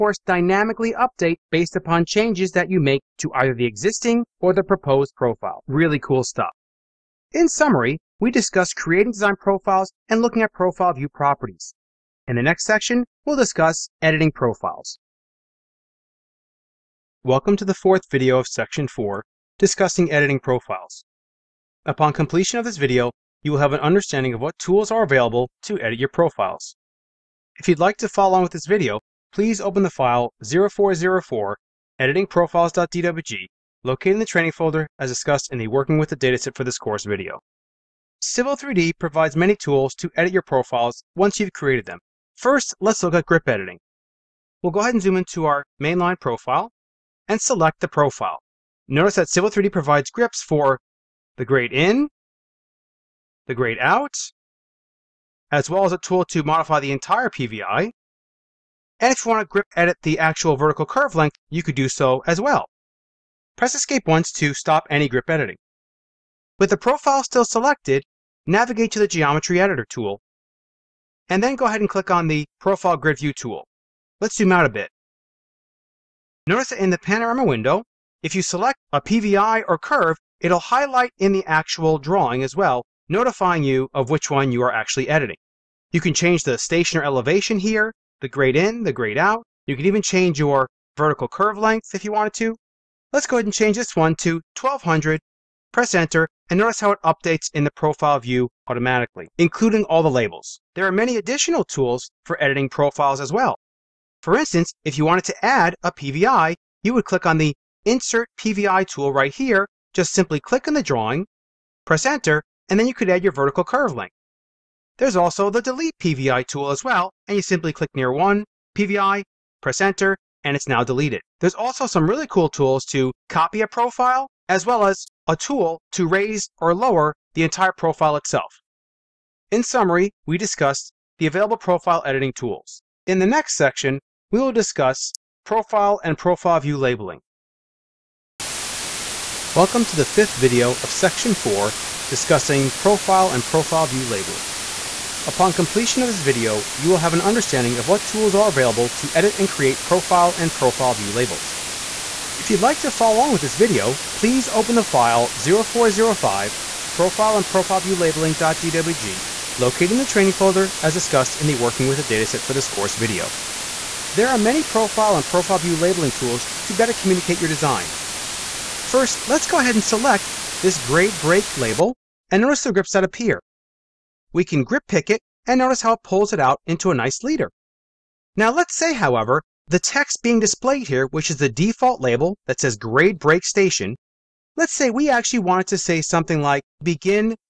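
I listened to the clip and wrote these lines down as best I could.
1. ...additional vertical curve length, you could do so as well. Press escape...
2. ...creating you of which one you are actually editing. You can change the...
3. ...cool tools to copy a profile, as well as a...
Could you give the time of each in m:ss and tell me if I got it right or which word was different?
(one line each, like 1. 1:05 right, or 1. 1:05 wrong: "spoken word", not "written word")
1. 1:00 wrong: "actual", not "additional"
2. 1:23 wrong: "notifying", not "creating"
3. 2:02 right.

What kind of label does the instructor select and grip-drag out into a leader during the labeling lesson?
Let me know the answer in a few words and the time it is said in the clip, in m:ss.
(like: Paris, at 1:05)
grade break label, at 2:50.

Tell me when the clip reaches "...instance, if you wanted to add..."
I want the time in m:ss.
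1:44.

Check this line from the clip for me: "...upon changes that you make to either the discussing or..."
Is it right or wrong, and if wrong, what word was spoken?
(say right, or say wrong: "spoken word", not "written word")
wrong: "existing", not "discussing".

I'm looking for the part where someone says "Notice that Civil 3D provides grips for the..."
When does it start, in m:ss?
0:48.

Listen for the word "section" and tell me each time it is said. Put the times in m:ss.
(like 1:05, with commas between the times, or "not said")
0:12, 0:18, 2:13, 2:20.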